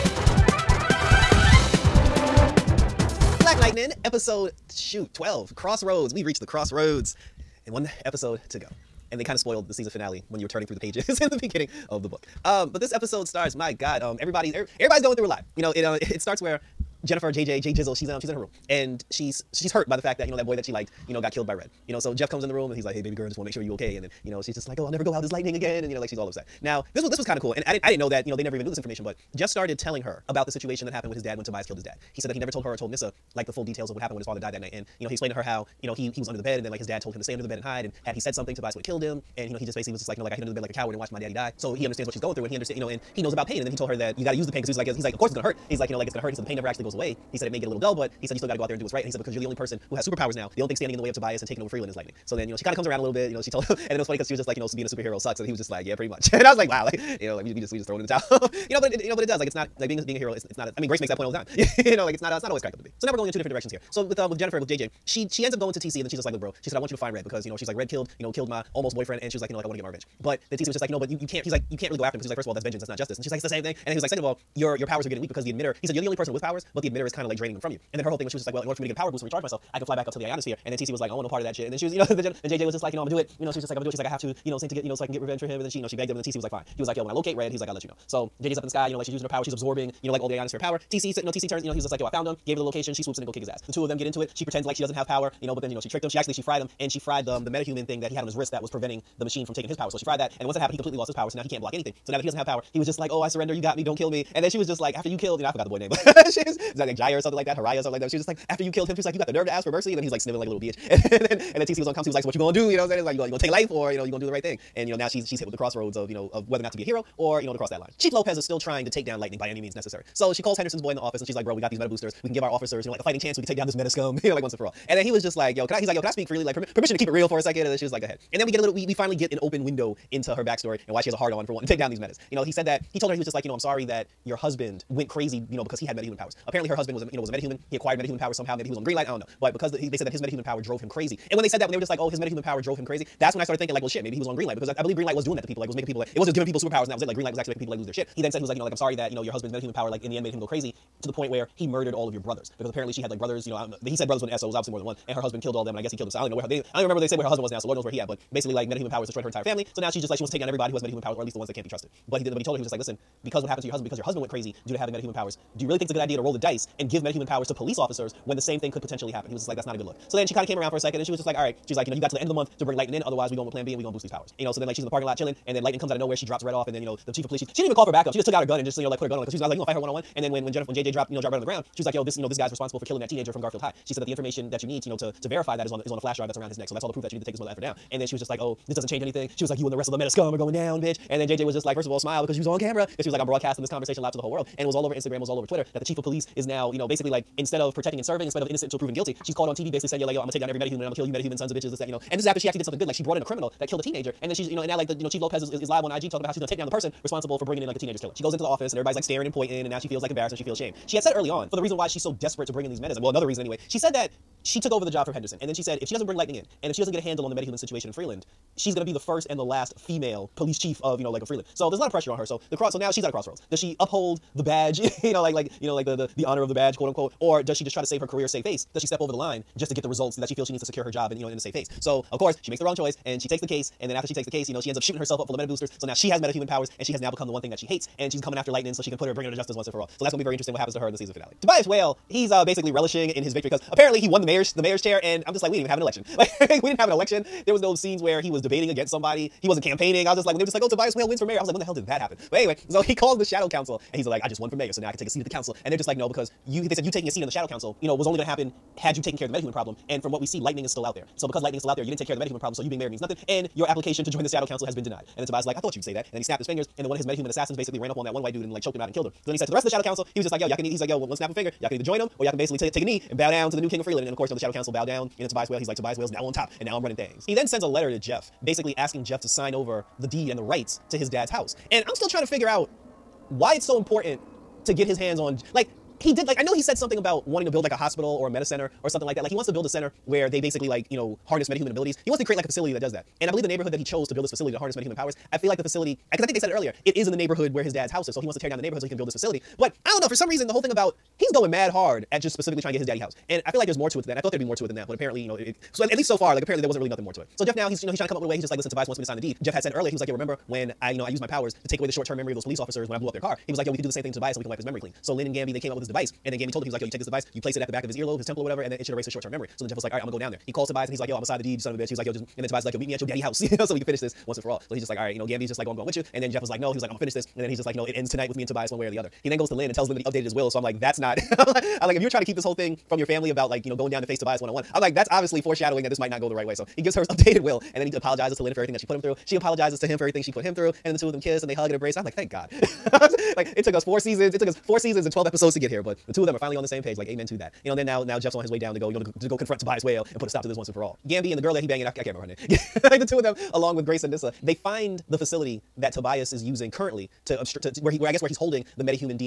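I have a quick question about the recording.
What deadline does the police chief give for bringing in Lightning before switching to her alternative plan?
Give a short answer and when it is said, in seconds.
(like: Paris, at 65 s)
End of the month, at 172 s.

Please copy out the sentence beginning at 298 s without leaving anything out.
So he wants to tear down the neighborhood so he can build this facility.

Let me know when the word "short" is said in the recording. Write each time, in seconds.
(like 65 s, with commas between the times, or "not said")
311 s, 319 s.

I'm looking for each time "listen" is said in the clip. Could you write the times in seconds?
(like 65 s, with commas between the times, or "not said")
162 s, 308 s.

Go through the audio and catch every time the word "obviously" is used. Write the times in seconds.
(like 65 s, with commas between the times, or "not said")
154 s, 335 s.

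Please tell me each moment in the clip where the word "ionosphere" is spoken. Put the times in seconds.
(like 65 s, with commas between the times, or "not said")
80 s, 90 s.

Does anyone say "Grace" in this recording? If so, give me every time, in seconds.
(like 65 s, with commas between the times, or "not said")
60 s, 353 s.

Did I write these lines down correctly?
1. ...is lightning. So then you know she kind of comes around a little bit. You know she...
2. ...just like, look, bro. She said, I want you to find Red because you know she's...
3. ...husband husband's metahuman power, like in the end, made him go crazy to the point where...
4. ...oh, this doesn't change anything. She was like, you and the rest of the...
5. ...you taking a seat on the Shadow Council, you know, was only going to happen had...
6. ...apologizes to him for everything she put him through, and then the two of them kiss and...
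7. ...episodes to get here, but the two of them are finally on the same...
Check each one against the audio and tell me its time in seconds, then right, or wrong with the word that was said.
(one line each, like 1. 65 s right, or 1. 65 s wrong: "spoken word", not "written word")
1. 51 s right
2. 66 s right
3. 149 s right
4. 188 s right
5. 256 s right
6. 339 s right
7. 345 s right.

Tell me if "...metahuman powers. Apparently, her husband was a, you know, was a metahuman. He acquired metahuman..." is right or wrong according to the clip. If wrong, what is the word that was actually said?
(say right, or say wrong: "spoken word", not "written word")
right.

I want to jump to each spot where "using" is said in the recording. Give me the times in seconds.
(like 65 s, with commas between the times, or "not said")
89 s, 356 s.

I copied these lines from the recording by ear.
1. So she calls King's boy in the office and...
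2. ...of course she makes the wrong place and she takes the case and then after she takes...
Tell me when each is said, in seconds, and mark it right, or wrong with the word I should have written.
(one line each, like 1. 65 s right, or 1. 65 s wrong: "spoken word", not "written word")
1. 120 s wrong: "Henderson", not "King"
2. 232 s wrong: "choice", not "place".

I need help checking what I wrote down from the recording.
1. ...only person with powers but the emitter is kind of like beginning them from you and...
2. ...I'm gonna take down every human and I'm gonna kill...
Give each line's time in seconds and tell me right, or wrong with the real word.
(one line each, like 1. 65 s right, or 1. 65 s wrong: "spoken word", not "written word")
1. 76 s wrong: "draining", not "beginning"
2. 200 s wrong: "metahuman", not "human".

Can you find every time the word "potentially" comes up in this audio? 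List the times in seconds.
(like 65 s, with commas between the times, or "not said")
168 s.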